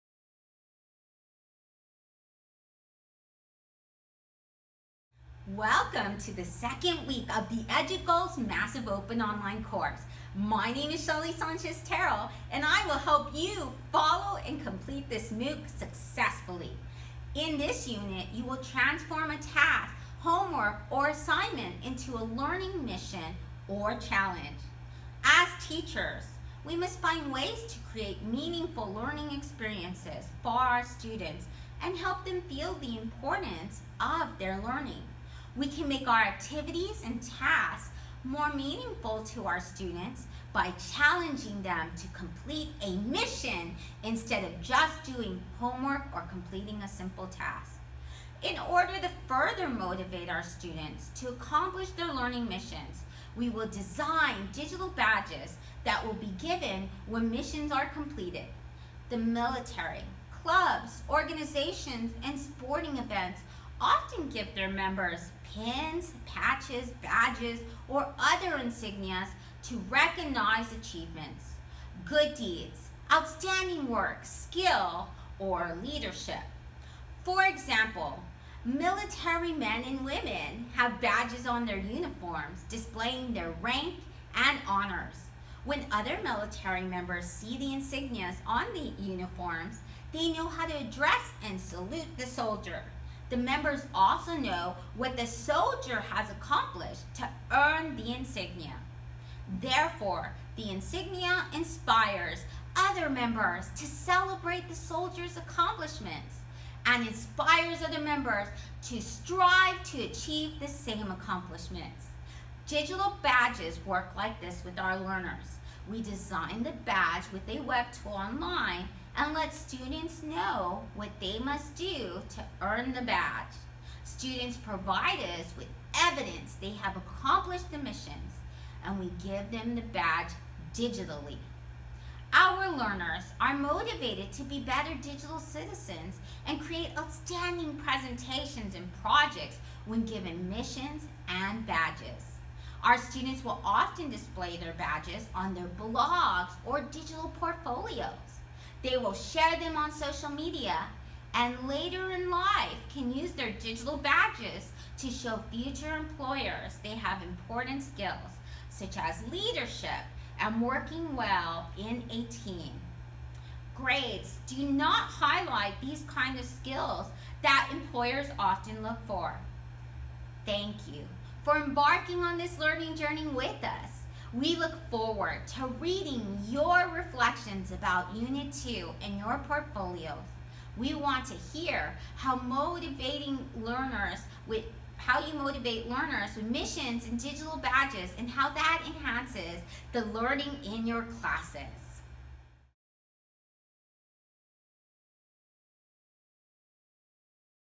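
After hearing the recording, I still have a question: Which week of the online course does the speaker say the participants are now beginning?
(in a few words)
second week.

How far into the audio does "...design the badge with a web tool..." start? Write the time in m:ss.
1:56.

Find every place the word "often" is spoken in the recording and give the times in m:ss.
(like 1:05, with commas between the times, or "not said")
1:03, 2:23, 2:48.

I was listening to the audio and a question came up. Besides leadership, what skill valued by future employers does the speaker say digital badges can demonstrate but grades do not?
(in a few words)
working well in a team.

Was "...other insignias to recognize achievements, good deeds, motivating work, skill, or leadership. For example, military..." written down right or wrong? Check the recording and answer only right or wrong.
wrong.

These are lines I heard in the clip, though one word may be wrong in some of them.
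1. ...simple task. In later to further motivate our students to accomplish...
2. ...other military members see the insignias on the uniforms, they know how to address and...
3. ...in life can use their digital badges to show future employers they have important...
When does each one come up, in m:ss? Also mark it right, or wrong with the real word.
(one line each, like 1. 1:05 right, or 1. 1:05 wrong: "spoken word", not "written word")
1. 0:46 wrong: "order", not "later"
2. 1:25 right
3. 2:32 right.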